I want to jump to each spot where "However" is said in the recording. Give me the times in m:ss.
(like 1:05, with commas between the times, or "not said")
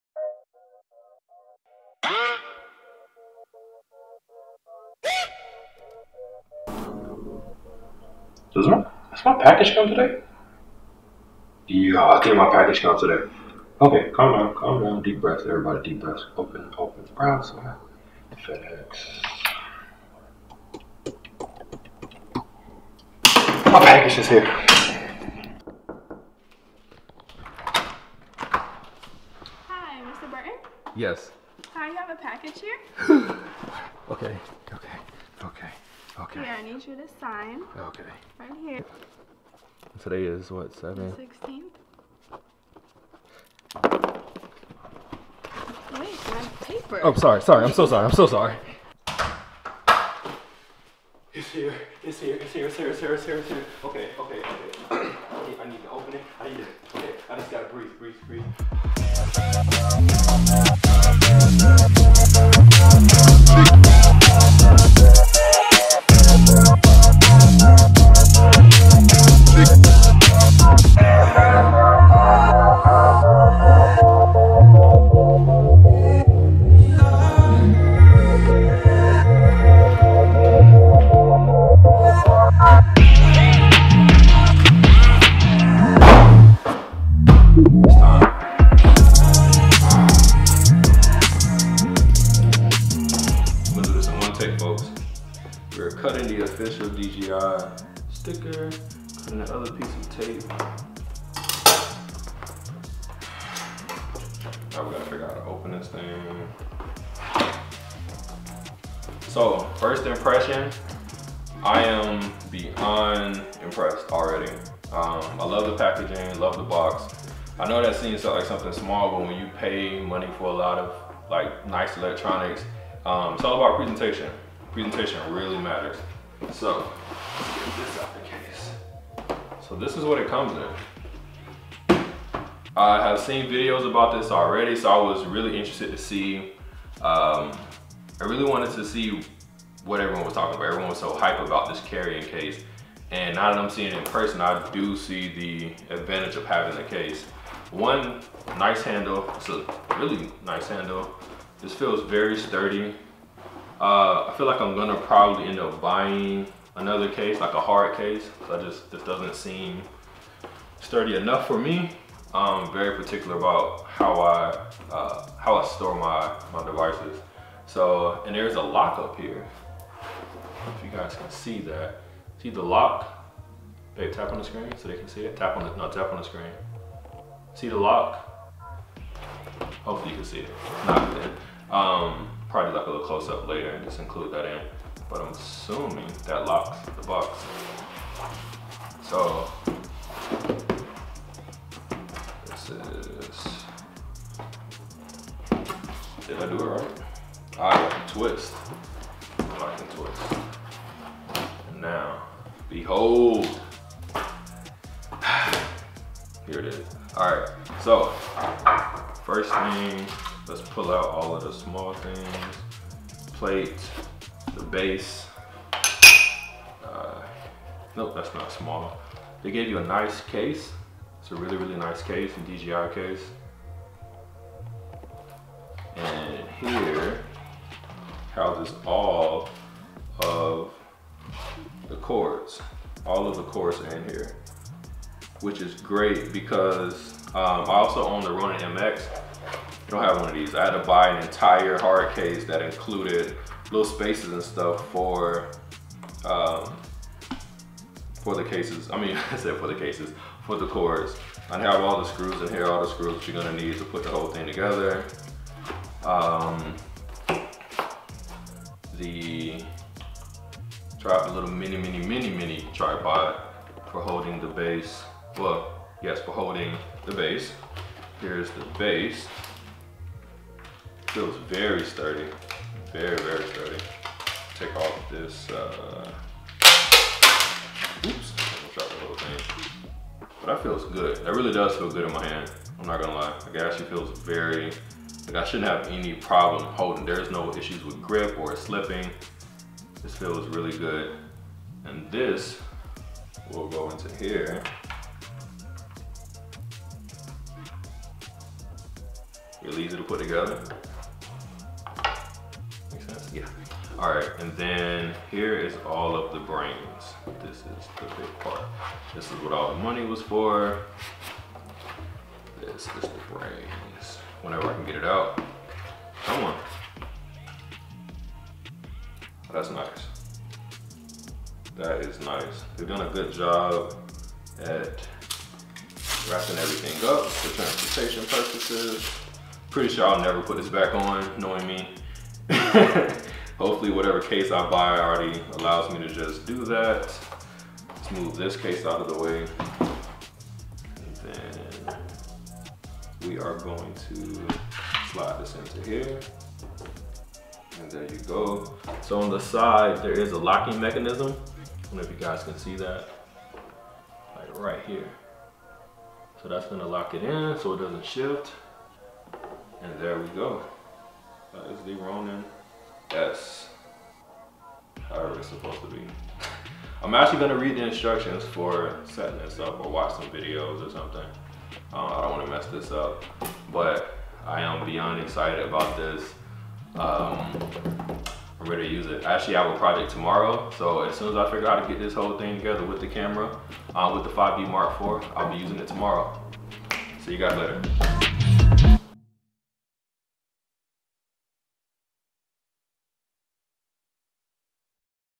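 6:05.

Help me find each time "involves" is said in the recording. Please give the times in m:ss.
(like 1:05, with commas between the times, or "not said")
not said.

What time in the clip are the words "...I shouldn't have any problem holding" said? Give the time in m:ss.
4:45.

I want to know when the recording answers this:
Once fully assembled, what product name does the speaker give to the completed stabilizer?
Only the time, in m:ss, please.
6:01.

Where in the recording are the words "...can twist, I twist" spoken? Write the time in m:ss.
3:17.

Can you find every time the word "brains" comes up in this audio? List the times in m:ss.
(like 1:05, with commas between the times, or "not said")
5:06, 5:13.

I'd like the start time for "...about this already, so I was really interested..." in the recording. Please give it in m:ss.
2:13.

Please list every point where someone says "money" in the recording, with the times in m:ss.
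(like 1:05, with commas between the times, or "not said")
2:00, 5:09.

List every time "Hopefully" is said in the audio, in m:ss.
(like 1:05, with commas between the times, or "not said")
2:59, 5:33.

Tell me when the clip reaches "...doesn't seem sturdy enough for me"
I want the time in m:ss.
2:39.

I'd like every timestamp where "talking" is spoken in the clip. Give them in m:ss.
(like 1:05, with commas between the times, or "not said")
2:20.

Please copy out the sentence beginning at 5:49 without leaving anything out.
So on the side, there is a locking mechanism.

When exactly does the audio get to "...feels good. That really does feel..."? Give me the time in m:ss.
4:40.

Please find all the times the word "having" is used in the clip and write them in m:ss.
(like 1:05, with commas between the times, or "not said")
2:26.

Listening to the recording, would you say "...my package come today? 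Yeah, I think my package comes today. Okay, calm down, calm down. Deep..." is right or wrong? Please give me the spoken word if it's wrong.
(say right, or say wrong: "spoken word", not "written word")
right.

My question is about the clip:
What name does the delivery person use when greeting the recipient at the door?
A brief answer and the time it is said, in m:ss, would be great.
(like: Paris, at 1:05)
Mr. Burton, at 0:30.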